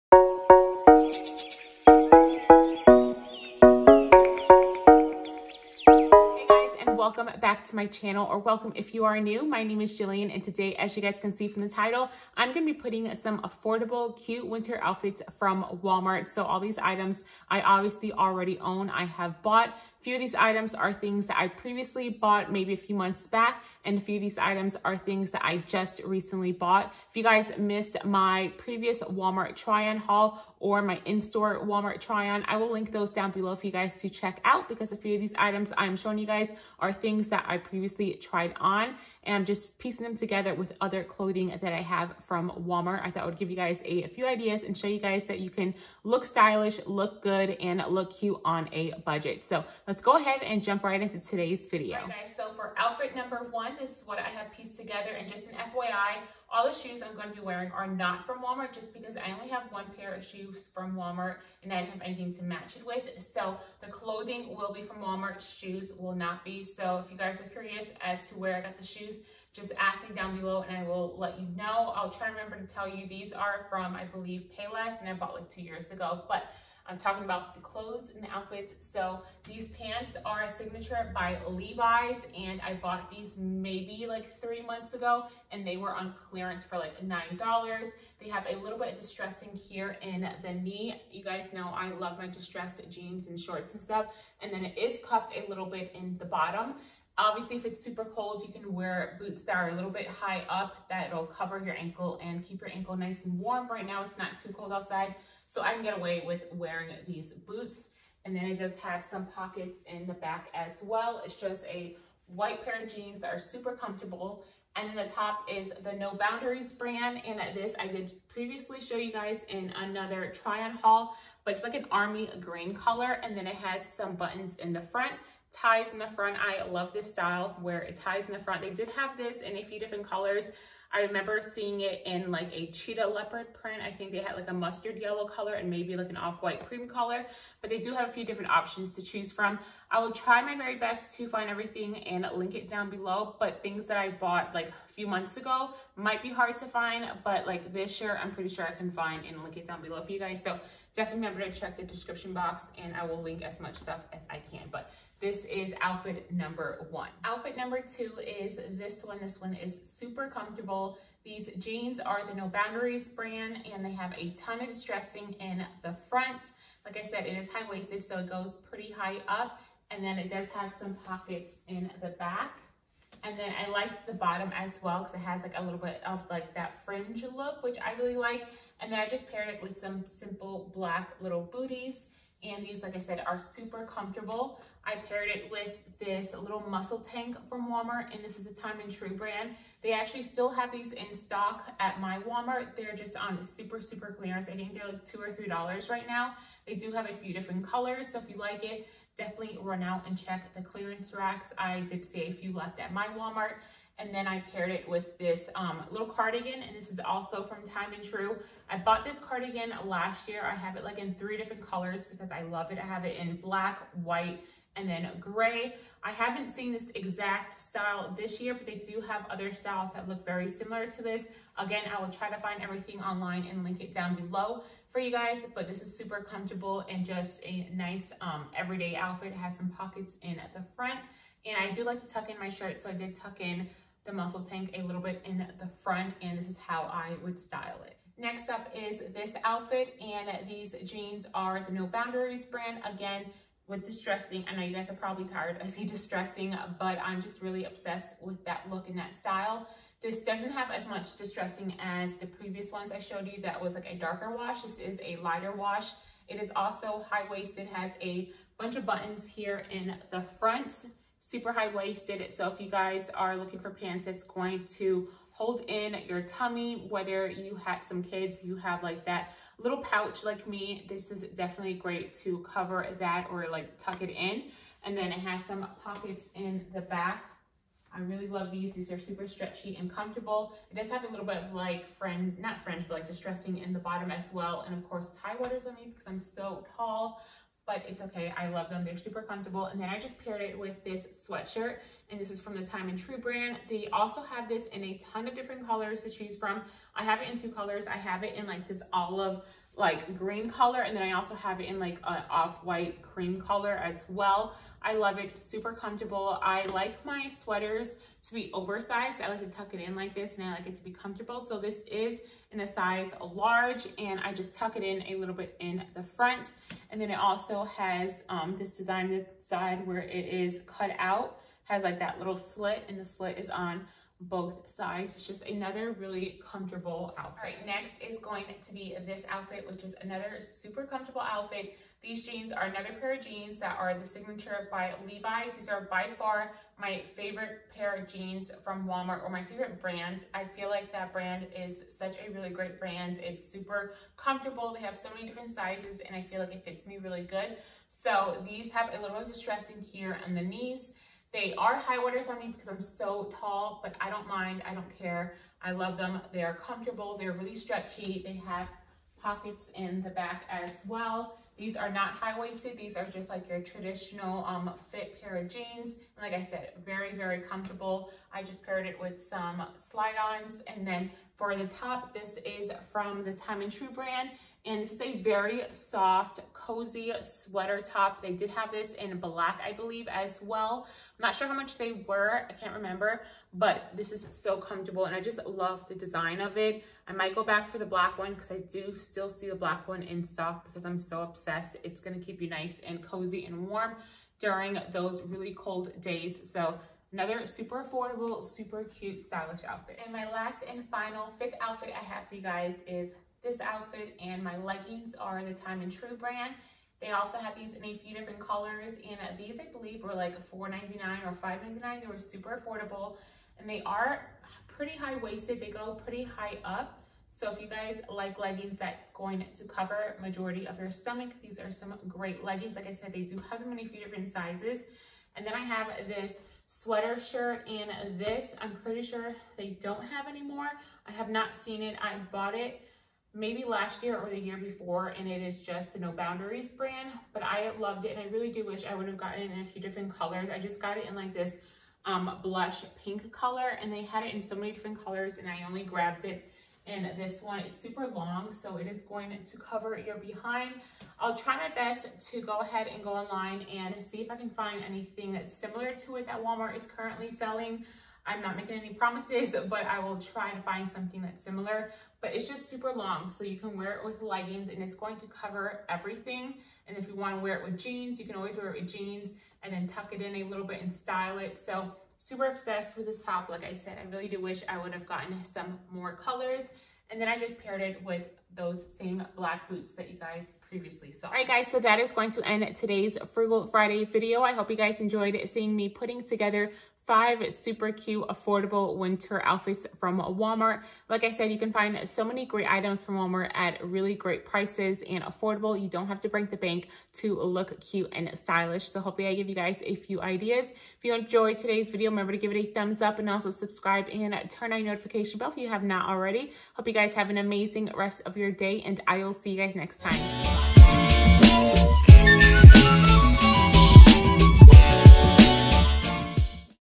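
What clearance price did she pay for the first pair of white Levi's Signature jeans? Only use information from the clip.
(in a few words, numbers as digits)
$9.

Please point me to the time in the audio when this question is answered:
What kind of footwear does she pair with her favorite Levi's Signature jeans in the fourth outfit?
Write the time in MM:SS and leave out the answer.
06:09.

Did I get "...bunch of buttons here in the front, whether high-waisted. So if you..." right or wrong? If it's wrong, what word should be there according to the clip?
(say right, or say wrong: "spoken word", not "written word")
wrong: "super", not "whether".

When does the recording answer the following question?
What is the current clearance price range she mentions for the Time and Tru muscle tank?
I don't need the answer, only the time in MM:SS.
03:15.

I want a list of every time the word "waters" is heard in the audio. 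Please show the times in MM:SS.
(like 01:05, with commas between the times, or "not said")
04:45, 05:51.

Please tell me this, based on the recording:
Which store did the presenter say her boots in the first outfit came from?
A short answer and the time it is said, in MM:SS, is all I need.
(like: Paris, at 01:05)
Payless, at 01:14.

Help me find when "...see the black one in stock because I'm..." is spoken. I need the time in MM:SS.
06:29.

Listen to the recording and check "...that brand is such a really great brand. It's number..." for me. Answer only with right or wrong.
wrong.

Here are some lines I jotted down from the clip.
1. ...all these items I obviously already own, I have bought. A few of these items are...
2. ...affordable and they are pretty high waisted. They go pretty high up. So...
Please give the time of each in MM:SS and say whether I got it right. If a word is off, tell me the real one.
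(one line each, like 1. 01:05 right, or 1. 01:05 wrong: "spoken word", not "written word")
1. 00:16 right
2. 06:52 right.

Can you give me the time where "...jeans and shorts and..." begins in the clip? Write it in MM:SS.
01:32.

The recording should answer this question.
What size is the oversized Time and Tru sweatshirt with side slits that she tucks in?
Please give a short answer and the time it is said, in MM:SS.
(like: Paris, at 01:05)
large, at 05:13.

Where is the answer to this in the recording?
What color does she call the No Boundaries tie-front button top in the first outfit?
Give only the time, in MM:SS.
02:01.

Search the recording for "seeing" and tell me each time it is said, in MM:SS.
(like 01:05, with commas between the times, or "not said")
02:11, 08:05.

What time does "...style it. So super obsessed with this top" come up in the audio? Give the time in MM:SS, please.
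07:50.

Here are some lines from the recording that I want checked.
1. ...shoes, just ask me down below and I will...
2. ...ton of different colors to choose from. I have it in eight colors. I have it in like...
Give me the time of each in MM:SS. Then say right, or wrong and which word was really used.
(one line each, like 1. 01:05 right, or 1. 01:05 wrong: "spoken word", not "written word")
1. 01:08 right
2. 04:55 wrong: "two", not "eight".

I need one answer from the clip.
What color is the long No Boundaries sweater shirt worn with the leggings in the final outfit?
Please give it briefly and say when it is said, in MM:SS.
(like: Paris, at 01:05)
blush pink, at 07:22.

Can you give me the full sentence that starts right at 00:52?
guys, so for outfit number one, this is what I have pieced together.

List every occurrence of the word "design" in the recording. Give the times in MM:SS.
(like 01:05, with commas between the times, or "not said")
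05:18, 06:25.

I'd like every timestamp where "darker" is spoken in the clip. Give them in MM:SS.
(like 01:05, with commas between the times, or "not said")
04:13.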